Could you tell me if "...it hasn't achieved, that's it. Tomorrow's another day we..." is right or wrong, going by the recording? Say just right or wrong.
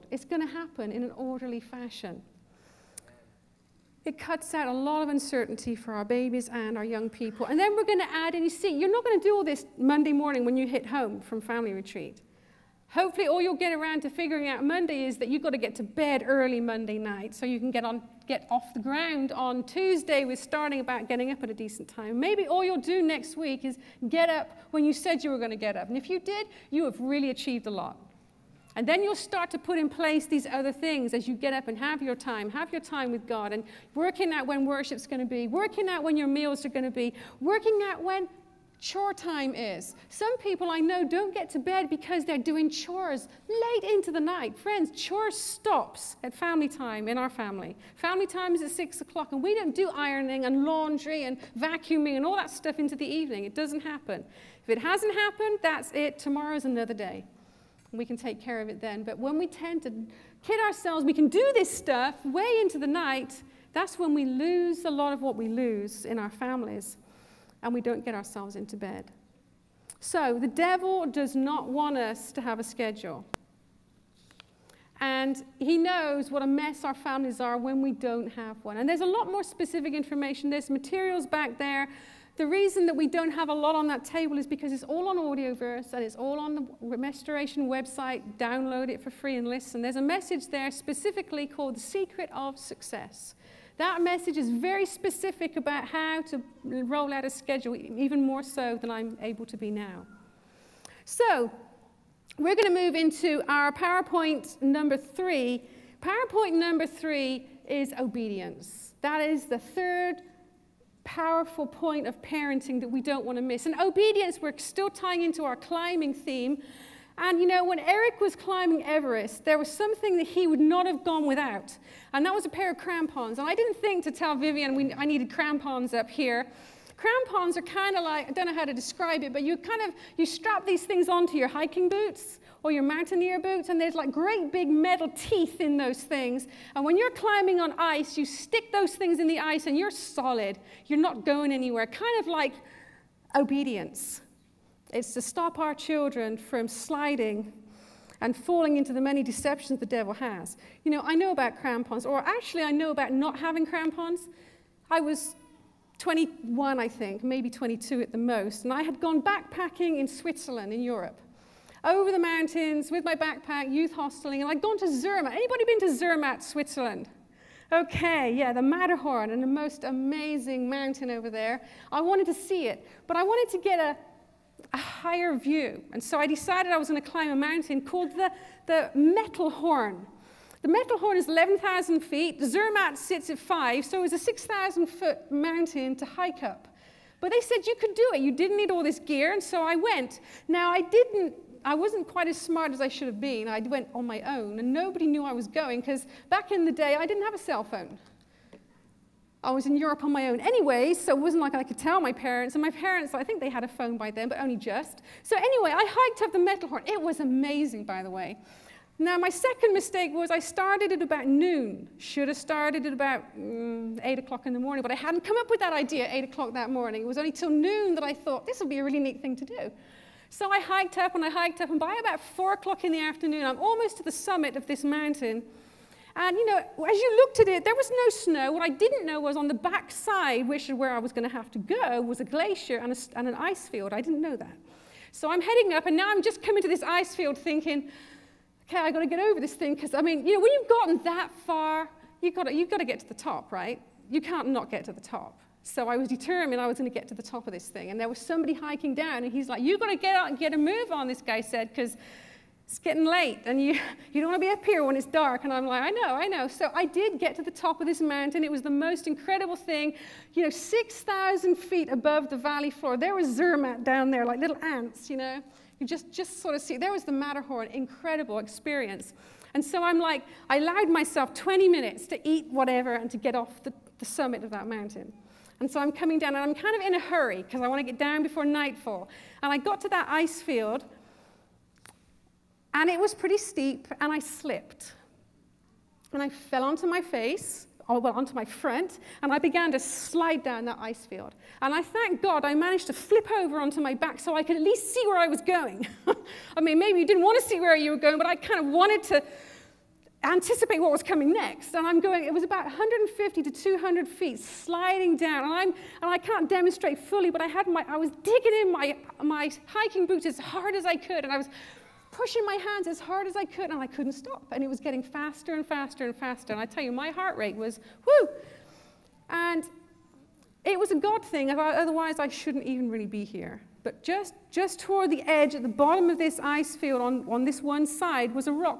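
wrong.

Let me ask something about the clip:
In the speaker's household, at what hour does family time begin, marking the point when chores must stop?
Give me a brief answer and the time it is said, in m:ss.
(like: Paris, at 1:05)
6 o'clock, at 0:48.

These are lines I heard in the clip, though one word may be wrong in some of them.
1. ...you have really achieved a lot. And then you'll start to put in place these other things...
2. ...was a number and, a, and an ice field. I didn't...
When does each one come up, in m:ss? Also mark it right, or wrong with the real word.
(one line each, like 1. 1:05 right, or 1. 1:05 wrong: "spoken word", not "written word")
1. 0:26 right
2. 3:51 wrong: "glacier", not "number".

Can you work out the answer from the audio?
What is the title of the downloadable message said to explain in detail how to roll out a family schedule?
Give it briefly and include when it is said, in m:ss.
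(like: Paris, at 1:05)
The Secret of Success, at 1:31.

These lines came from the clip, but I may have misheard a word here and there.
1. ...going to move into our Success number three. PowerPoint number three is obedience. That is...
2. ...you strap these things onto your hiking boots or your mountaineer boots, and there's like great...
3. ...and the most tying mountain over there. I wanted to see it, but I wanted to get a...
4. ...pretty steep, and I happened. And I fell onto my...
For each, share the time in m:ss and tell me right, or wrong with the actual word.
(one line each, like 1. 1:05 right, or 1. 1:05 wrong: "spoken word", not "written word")
1. 1:42 wrong: "PowerPoint", not "Success"
2. 2:10 right
3. 2:49 wrong: "amazing", not "tying"
4. 4:43 wrong: "slipped", not "happened".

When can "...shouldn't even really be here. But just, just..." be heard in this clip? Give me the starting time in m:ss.
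5:22.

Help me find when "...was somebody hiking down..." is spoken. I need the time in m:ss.
4:08.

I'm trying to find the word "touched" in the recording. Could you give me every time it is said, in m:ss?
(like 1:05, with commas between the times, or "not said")
not said.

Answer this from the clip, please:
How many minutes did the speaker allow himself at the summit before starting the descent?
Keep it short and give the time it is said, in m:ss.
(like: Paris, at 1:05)
20, at 4:31.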